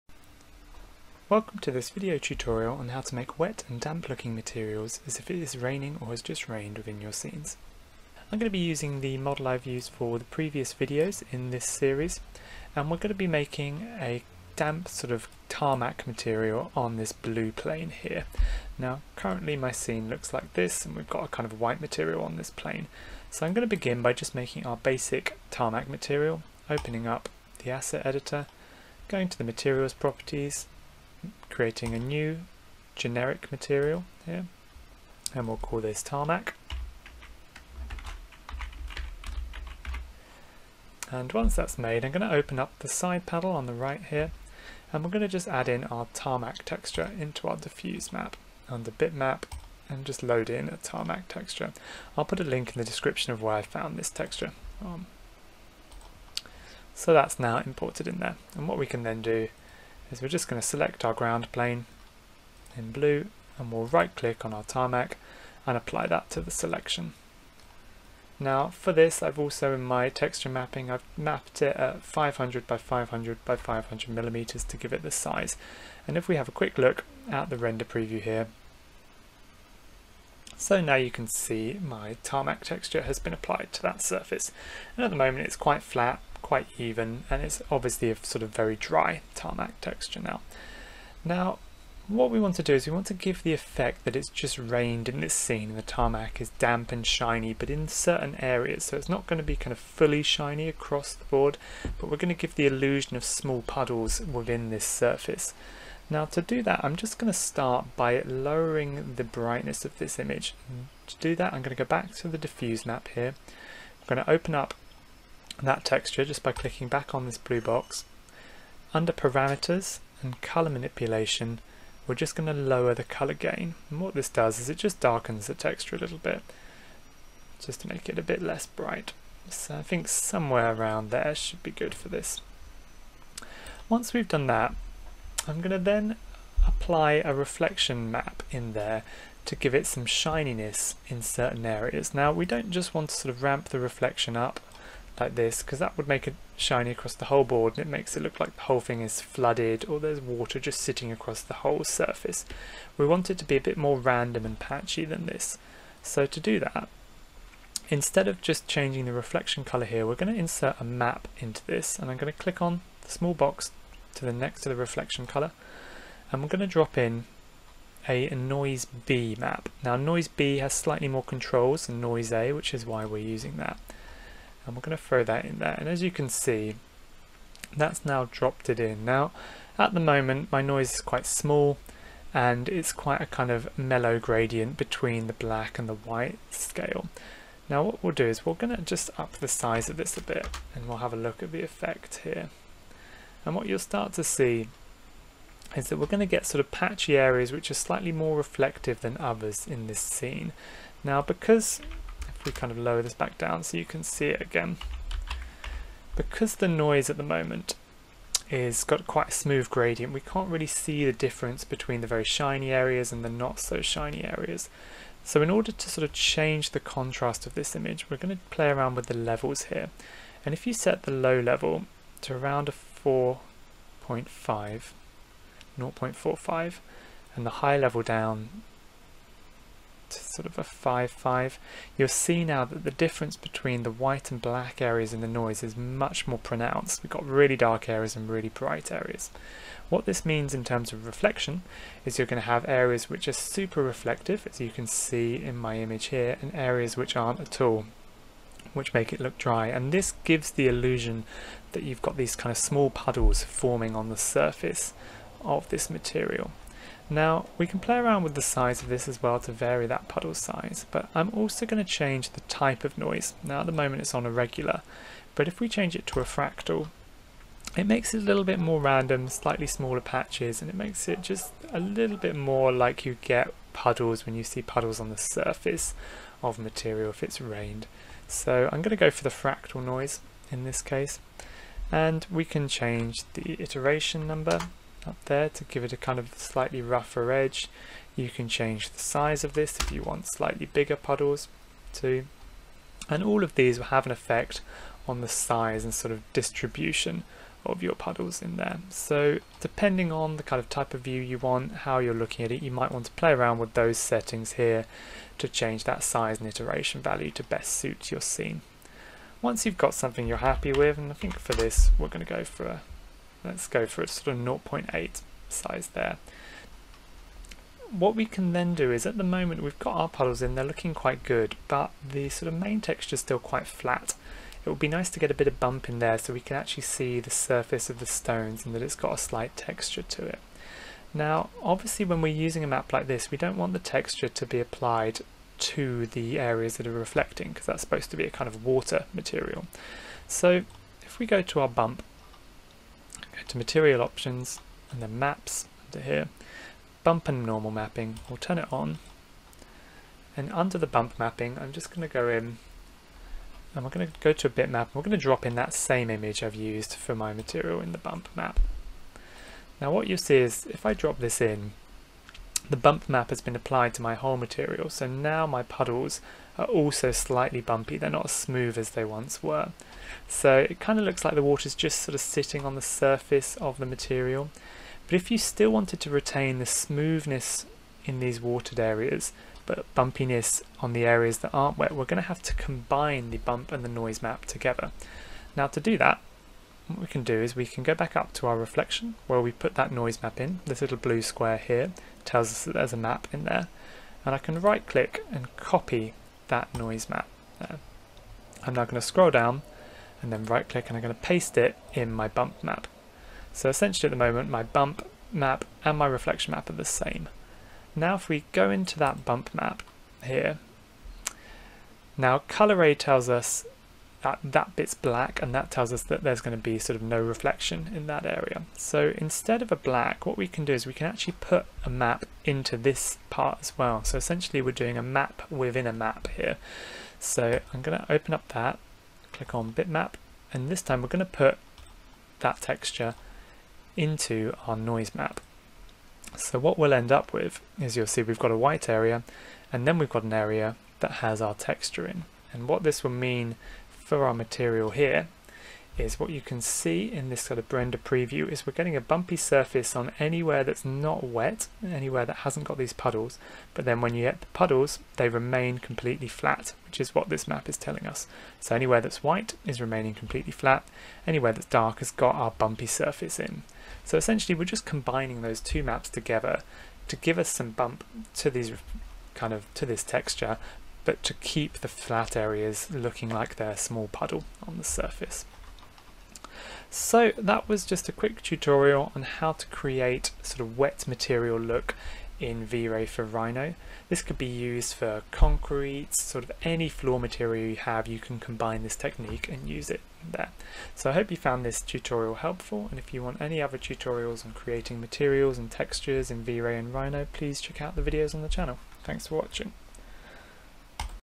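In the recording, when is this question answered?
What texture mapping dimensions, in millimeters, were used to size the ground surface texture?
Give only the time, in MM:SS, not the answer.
01:12.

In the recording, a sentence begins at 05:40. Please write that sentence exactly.
So if we go to our bump, to material options and then maps under here.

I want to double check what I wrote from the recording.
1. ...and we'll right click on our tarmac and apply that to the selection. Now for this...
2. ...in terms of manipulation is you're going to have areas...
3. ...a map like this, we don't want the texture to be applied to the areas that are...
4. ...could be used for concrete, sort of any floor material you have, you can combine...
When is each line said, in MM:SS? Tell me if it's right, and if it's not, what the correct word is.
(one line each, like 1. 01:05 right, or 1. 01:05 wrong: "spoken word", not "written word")
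1. 01:03 right
2. 04:00 wrong: "reflection", not "manipulation"
3. 05:32 right
4. 08:04 right.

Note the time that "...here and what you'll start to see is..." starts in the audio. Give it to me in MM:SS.
03:12.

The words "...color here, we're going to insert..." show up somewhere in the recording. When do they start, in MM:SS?
02:39.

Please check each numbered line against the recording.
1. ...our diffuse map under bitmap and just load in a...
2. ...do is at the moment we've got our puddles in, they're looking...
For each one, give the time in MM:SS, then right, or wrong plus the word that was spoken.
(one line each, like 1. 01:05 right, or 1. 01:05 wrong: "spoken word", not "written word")
1. 00:47 right
2. 05:18 right.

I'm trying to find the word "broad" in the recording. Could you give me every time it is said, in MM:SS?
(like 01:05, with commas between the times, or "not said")
not said.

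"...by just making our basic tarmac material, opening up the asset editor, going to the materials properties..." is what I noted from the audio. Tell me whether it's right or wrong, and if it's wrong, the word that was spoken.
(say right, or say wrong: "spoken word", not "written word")
right.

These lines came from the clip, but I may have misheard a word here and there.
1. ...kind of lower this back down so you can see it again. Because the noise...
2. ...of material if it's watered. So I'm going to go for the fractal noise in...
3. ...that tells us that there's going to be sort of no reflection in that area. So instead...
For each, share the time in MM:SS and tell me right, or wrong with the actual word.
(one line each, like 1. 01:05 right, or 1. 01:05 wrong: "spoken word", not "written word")
1. 03:22 right
2. 04:36 wrong: "rained", not "watered"
3. 06:55 right.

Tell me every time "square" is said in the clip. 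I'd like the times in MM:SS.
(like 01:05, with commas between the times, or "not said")
06:31.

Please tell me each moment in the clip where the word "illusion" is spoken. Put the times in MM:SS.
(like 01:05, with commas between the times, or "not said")
01:42, 04:10.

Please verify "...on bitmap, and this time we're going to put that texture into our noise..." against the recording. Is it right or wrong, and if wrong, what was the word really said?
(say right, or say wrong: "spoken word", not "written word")
right.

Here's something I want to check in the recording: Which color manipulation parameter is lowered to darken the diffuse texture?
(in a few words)
color gain.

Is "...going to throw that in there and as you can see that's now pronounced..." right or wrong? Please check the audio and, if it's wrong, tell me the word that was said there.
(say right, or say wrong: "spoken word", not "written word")
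wrong: "dropped", not "pronounced".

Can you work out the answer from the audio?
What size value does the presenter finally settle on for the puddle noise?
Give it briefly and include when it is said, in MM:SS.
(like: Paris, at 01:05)
0.8, at 05:14.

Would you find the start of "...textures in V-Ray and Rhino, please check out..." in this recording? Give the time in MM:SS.
08:15.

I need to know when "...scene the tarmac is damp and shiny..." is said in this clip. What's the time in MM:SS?
01:35.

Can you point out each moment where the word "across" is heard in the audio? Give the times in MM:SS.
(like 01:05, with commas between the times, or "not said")
01:40, 02:26, 02:31.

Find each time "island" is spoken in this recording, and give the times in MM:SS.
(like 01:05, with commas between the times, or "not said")
not said.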